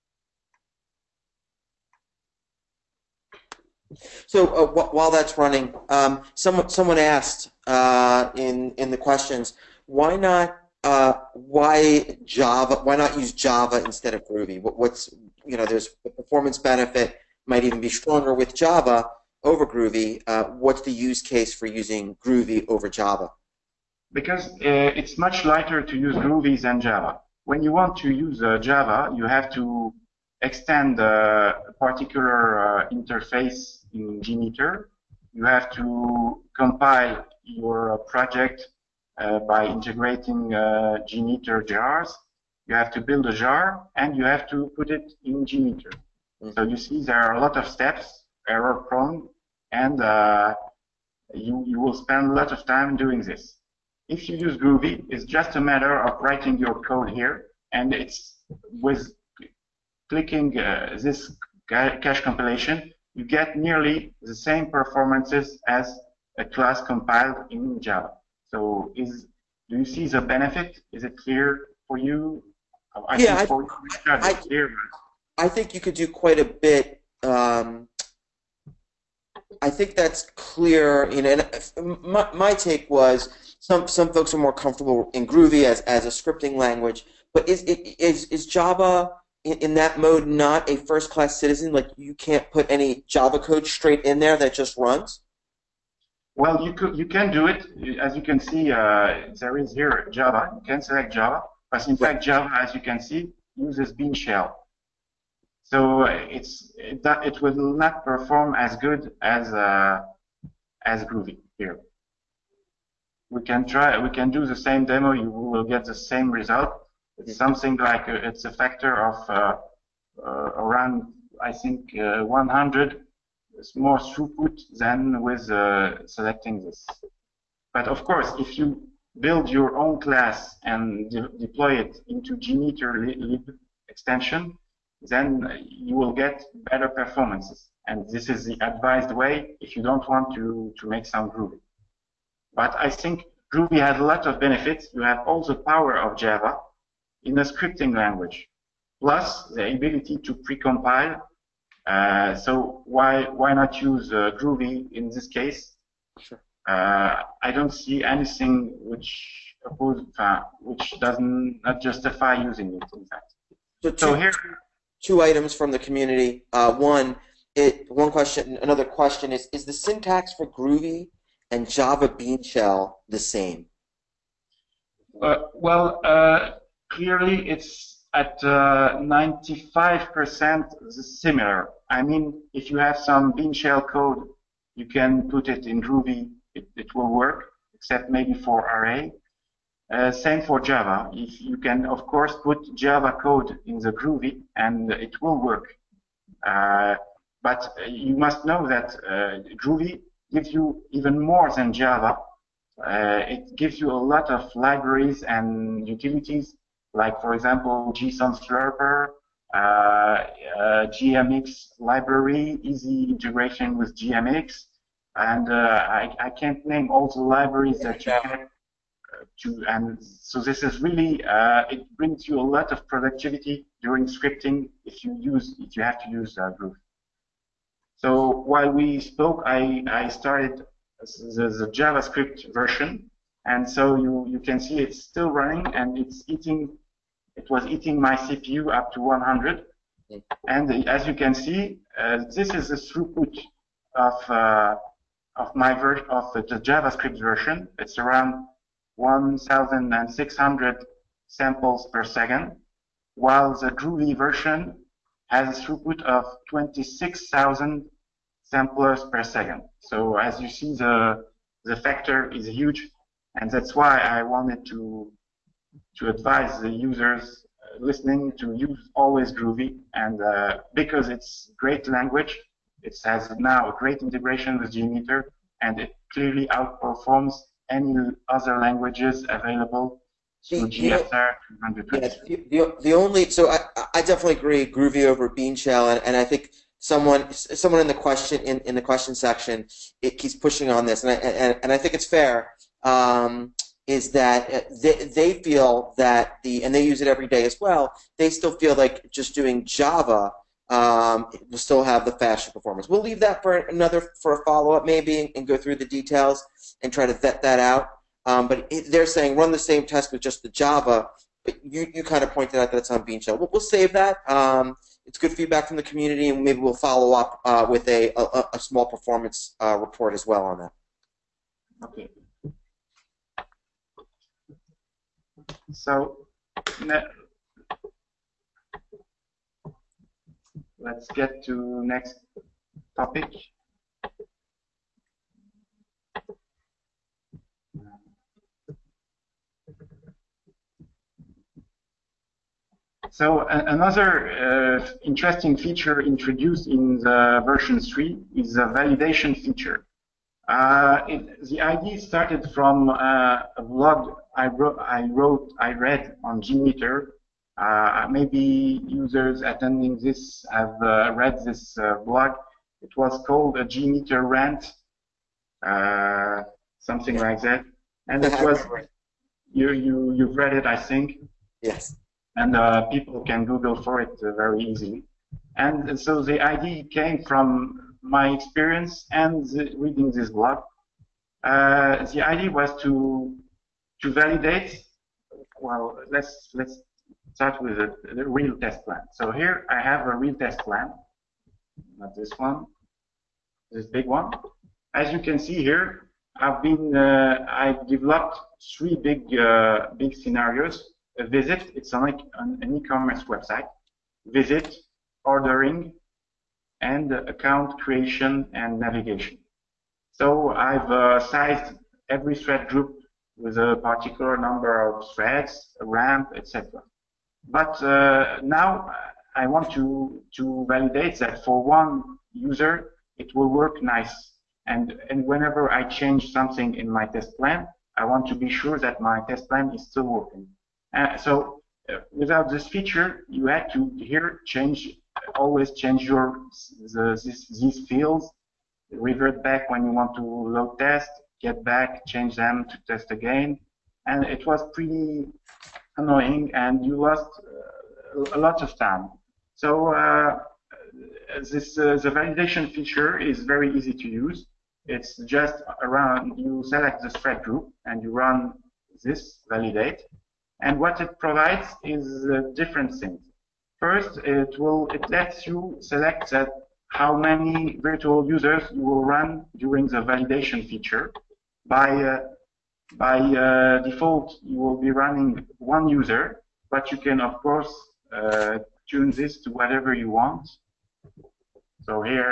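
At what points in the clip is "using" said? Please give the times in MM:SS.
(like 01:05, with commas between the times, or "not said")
00:21, 02:42.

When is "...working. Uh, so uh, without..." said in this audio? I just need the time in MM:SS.
07:10.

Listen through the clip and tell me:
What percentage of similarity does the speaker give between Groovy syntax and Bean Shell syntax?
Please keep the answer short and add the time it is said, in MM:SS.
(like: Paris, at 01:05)
95%, at 02:58.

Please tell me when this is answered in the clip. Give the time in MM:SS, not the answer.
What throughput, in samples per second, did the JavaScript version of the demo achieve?
04:08.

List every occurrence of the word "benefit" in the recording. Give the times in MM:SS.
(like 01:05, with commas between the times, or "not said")
00:16, 01:10, 02:24.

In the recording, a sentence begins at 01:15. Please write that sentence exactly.
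I think you could do quite a bit.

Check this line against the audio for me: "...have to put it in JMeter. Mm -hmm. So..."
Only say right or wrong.
right.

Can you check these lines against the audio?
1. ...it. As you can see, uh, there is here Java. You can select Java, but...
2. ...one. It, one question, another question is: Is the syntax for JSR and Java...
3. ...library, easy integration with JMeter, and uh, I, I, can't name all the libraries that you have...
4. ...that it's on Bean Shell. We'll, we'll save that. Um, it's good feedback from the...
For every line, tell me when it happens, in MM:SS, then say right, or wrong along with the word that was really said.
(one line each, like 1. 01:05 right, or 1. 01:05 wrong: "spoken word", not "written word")
1. 01:37 right
2. 02:46 wrong: "Groovy", not "JSR"
3. 03:31 wrong: "JMX", not "JMeter"
4. 05:12 right.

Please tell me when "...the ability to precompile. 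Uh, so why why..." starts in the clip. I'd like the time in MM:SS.
02:29.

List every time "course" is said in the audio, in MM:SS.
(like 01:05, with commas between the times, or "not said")
02:08, 03:12, 07:57.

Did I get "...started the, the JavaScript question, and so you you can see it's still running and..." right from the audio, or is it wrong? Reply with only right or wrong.
wrong.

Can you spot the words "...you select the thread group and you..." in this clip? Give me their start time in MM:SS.
07:36.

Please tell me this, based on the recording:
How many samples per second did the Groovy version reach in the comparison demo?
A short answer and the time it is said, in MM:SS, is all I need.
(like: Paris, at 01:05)
26,000, at 04:16.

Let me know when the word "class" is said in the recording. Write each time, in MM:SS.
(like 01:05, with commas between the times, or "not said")
01:06, 01:31, 02:10.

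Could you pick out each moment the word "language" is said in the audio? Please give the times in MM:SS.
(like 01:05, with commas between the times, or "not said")
01:26, 02:27, 04:31, 04:38.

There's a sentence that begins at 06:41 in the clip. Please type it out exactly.
A visit, it's like an, an e-commerce website.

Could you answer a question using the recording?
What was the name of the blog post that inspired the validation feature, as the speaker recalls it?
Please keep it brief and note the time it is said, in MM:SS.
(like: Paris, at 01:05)
A JMeter rant, at 06:03.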